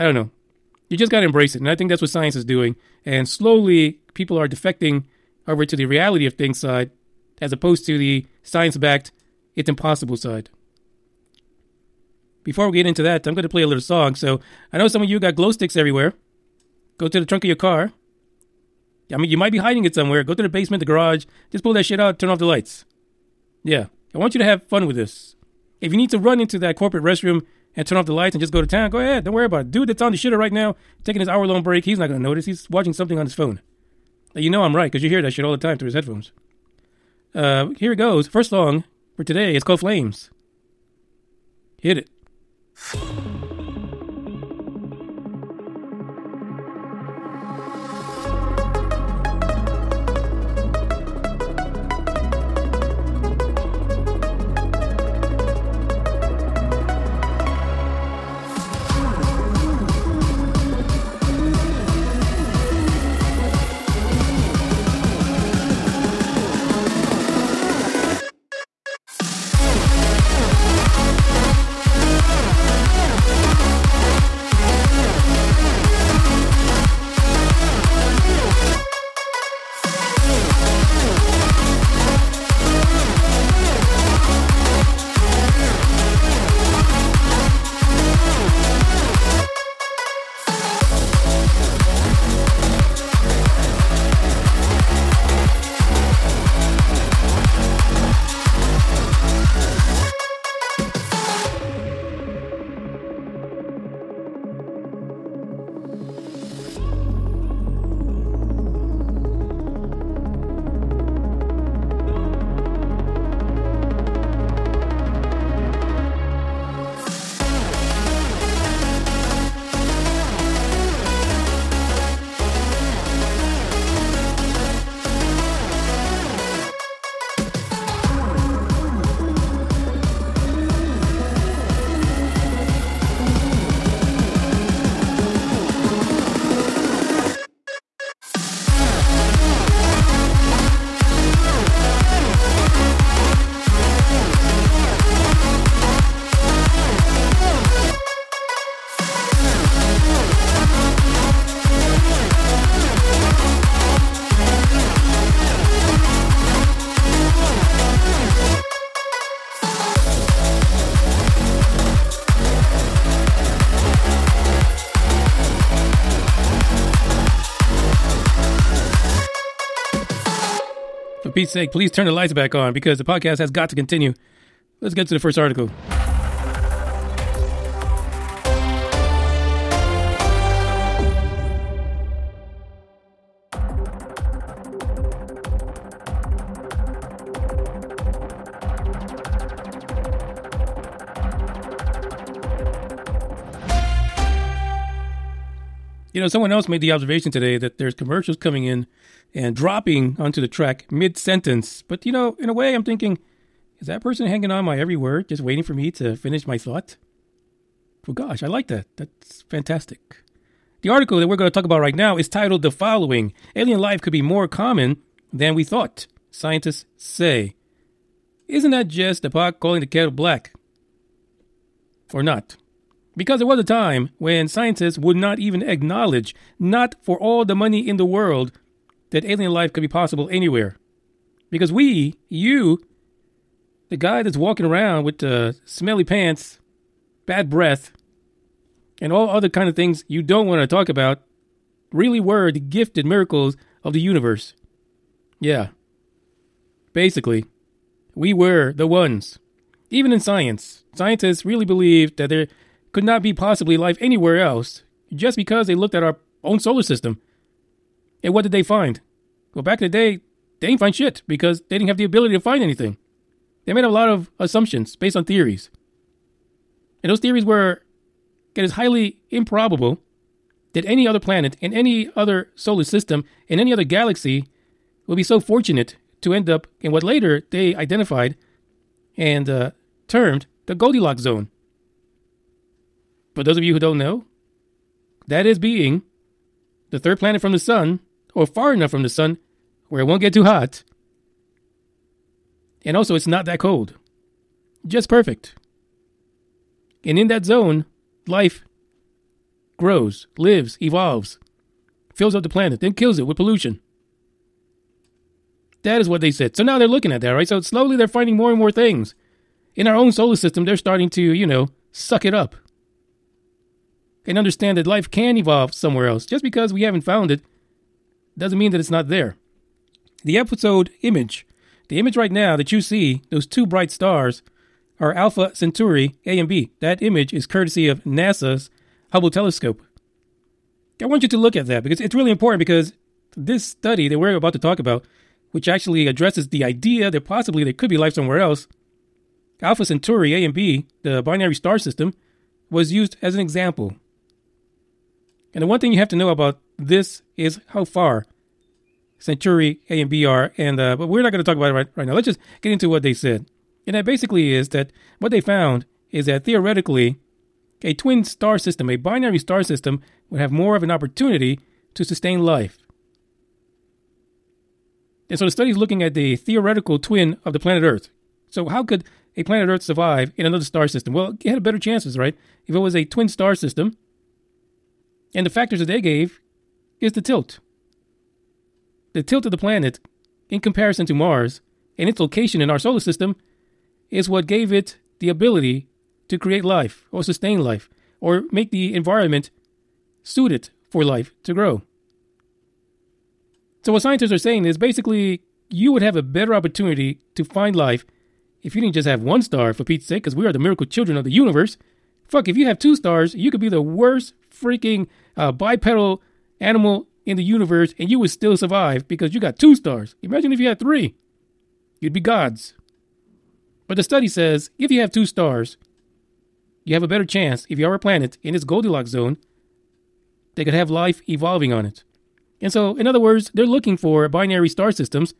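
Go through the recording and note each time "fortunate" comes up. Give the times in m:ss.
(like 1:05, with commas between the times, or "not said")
4:35.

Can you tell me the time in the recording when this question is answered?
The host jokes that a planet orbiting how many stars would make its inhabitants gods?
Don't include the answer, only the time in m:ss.
6:50.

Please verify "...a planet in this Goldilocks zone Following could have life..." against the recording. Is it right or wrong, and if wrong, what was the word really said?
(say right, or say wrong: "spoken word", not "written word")
wrong: "They", not "Following".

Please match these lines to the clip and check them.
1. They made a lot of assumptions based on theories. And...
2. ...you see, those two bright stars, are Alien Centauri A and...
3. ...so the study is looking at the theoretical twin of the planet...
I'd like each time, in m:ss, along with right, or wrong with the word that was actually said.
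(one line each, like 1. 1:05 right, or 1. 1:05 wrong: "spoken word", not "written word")
1. 4:23 right
2. 5:22 wrong: "Alpha", not "Alien"
3. 6:05 right.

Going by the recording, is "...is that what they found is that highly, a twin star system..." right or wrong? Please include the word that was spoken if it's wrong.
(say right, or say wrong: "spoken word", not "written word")
wrong: "theoretically", not "highly".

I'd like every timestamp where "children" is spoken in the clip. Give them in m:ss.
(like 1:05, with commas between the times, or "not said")
6:40.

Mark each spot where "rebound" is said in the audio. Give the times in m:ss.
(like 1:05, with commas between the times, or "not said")
not said.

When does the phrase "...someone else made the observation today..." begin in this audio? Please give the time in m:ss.
3:16.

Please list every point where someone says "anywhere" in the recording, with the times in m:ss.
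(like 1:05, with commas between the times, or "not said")
3:50, 4:13.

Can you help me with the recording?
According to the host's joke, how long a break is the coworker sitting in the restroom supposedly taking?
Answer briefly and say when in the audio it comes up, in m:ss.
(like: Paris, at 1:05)
hour long, at 0:31.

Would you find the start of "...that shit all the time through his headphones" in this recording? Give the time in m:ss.
0:35.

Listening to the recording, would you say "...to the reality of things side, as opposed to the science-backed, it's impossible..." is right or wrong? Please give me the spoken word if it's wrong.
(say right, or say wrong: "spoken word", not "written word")
right.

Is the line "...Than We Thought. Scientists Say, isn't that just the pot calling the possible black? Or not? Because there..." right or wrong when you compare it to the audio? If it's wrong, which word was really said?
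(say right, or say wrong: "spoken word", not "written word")
wrong: "kettle", not "possible".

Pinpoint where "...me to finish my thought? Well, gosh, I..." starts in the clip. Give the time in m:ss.
3:25.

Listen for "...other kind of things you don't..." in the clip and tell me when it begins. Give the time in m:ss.
3:59.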